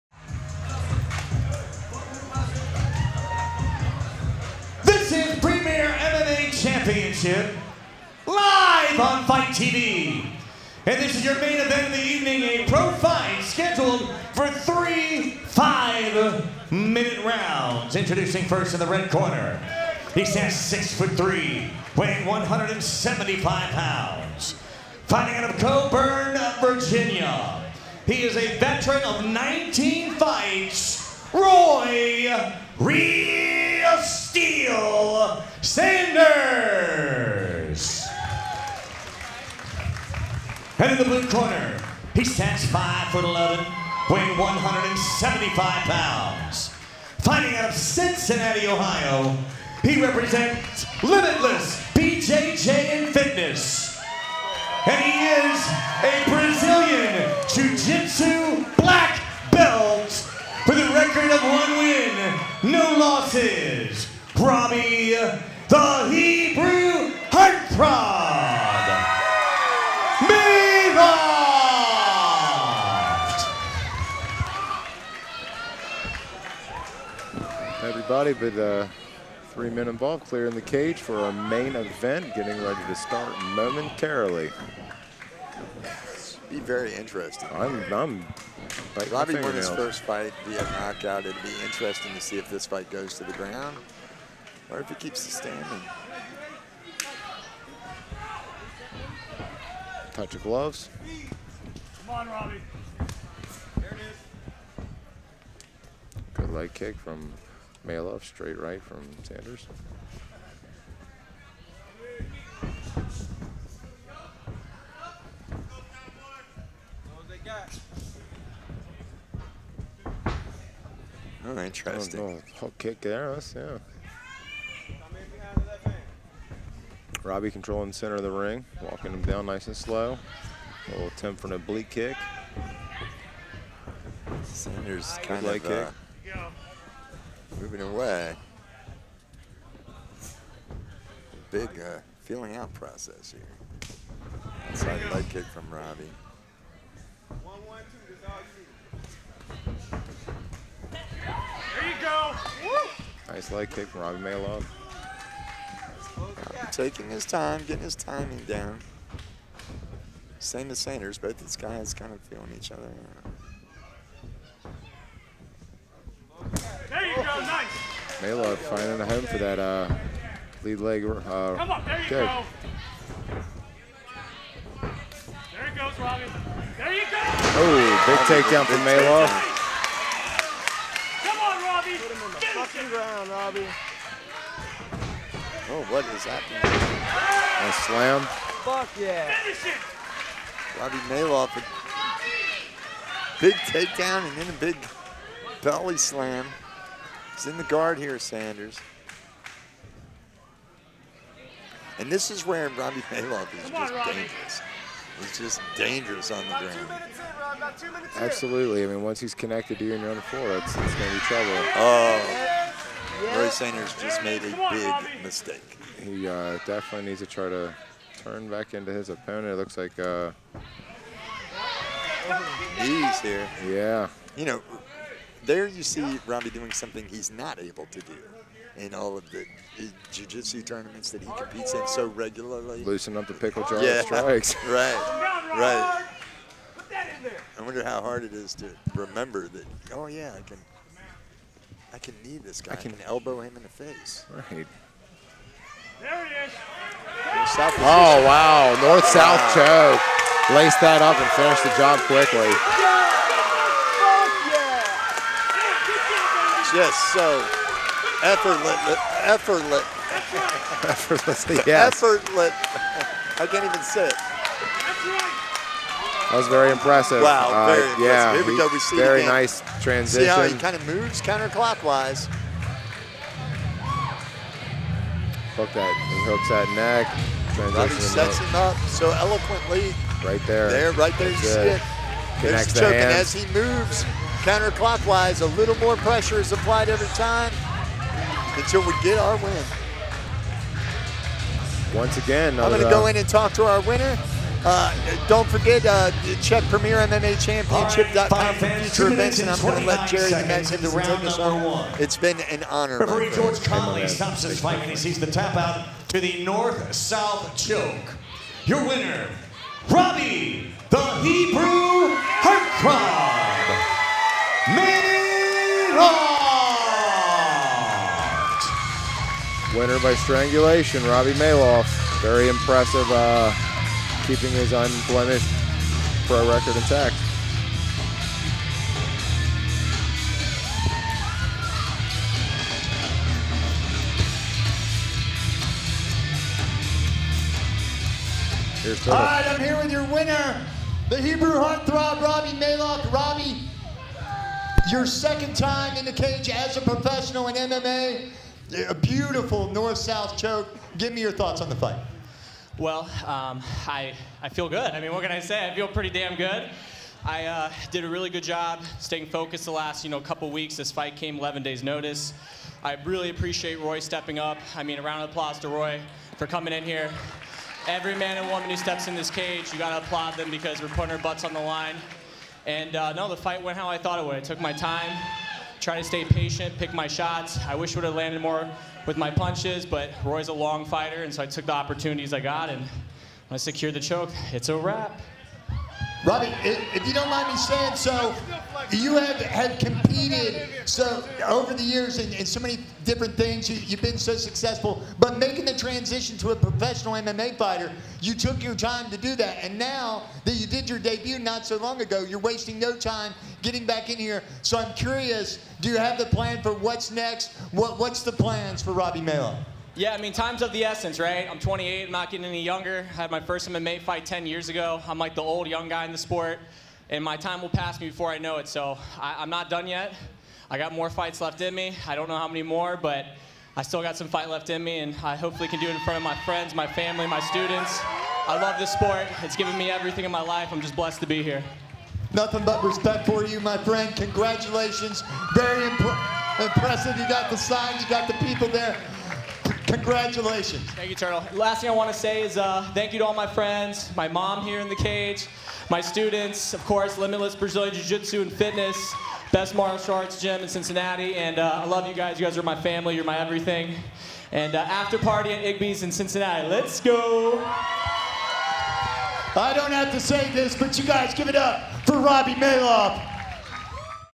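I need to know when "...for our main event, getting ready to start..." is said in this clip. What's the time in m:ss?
1:20.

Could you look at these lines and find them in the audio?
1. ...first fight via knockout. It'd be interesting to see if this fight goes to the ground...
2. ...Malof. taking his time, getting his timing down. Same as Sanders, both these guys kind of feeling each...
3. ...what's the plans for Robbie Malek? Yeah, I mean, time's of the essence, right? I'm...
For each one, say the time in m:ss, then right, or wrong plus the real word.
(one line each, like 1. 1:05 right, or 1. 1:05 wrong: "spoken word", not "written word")
1. 1:29 right
2. 2:34 right
3. 6:47 right.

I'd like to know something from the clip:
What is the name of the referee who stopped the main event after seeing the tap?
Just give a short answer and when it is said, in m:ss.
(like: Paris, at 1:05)
George Conley, at 5:03.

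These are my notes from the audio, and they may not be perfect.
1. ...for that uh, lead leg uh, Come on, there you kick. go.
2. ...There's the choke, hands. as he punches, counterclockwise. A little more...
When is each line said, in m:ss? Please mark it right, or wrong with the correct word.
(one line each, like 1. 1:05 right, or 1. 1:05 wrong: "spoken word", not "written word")
1. 2:49 right
2. 4:42 wrong: "moves", not "punches".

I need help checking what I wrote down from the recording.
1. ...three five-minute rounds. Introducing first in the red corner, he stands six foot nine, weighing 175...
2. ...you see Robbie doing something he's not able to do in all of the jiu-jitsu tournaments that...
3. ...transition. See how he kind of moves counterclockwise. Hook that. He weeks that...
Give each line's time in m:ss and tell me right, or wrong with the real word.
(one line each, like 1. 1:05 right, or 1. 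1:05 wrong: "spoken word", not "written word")
1. 0:14 wrong: "three", not "nine"
2. 3:45 right
3. 4:29 wrong: "hooks", not "weeks".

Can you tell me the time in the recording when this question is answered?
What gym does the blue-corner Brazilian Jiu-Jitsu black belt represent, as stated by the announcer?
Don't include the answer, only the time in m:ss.
0:51.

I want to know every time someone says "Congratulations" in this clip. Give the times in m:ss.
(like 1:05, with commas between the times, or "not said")
7:14, 7:19.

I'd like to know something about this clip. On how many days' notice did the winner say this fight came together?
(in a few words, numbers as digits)
11.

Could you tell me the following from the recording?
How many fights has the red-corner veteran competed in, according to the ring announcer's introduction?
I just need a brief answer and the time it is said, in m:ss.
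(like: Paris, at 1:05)
19, at 0:29.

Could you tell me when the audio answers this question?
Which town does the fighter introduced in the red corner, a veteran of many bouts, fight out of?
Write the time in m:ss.
0:25.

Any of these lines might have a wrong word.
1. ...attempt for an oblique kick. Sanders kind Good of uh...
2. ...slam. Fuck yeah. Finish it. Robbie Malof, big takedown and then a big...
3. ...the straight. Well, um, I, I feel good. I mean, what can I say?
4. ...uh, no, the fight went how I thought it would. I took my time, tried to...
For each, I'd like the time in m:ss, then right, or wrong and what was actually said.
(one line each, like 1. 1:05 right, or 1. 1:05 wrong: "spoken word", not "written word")
1. 2:11 right
2. 3:07 right
3. 5:51 wrong: "fight", not "straight"
4. 6:12 right.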